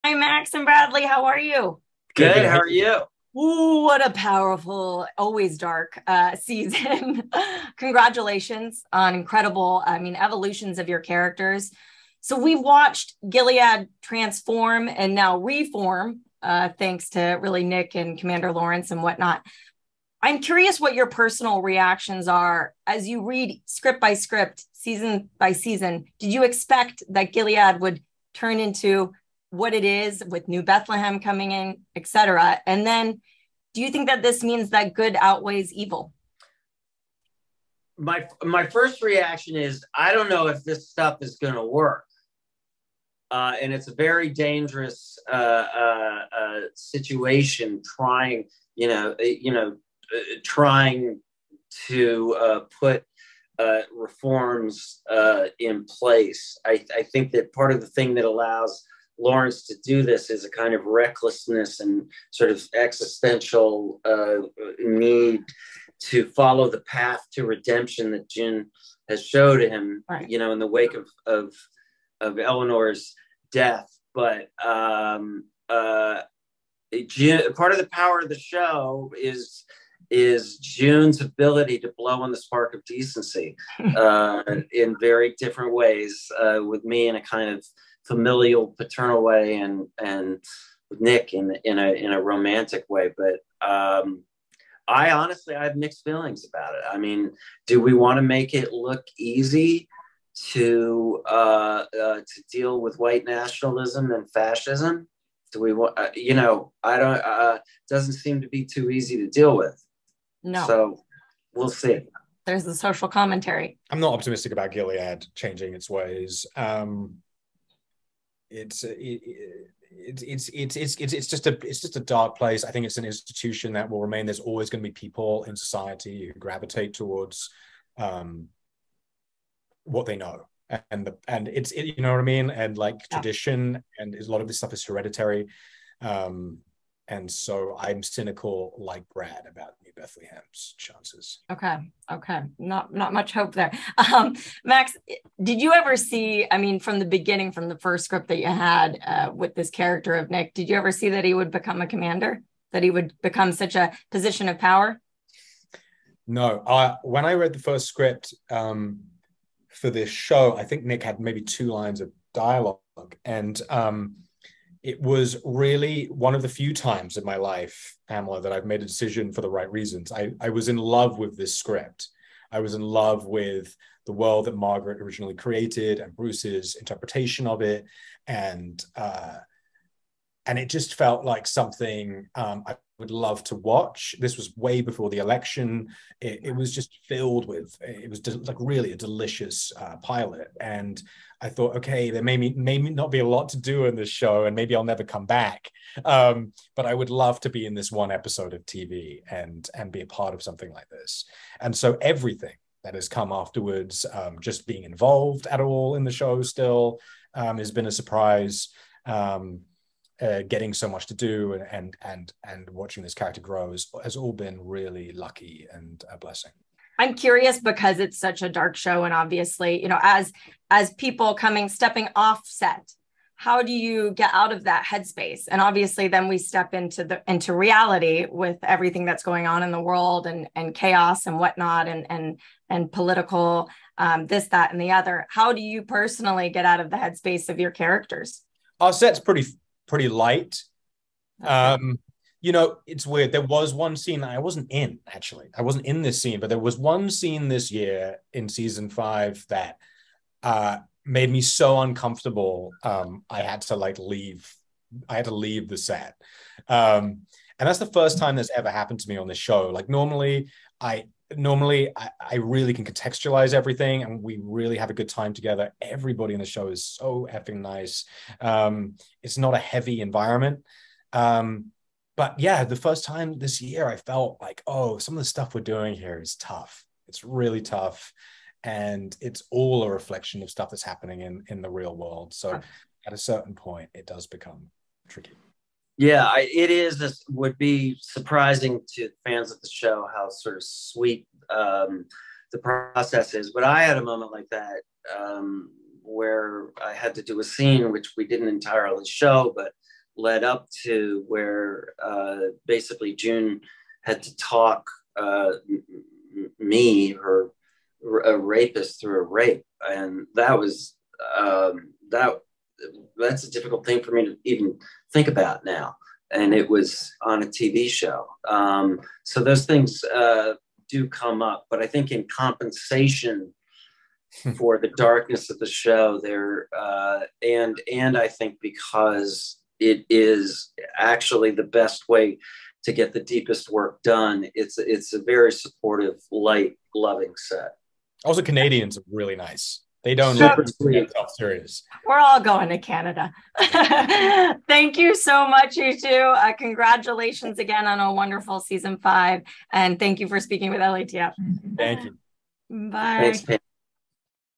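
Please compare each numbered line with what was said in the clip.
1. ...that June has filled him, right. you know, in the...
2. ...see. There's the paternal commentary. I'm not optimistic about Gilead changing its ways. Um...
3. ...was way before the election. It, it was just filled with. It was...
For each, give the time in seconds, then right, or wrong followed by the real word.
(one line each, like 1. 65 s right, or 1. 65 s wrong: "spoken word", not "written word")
1. 68 s wrong: "showed", not "filled"
2. 111 s wrong: "social", not "paternal"
3. 184 s right.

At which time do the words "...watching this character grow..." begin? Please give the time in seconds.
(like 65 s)
212 s.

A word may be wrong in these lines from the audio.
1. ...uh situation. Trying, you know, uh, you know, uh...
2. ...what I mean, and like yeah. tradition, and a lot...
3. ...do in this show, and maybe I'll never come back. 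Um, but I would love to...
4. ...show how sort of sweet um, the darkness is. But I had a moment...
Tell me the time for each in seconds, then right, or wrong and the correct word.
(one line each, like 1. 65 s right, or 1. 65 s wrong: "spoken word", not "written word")
1. 46 s right
2. 132 s right
3. 193 s right
4. 289 s wrong: "process", not "darkness".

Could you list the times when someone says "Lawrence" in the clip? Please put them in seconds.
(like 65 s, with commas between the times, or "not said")
18 s, 59 s.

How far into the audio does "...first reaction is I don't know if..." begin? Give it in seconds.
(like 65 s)
38 s.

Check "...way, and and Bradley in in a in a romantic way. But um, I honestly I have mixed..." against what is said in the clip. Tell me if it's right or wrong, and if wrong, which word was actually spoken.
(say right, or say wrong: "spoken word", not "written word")
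wrong: "Nick", not "Bradley".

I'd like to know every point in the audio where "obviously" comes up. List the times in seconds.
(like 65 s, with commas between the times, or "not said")
219 s, 225 s.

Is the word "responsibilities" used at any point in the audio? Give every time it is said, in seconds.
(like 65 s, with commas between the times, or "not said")
not said.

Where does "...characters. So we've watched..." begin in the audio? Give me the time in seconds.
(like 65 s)
10 s.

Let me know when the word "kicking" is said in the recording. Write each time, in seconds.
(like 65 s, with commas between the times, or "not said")
not said.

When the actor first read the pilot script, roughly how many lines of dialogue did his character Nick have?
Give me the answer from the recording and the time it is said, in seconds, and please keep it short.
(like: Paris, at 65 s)
2, at 161 s.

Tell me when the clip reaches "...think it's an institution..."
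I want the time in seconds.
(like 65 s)
122 s.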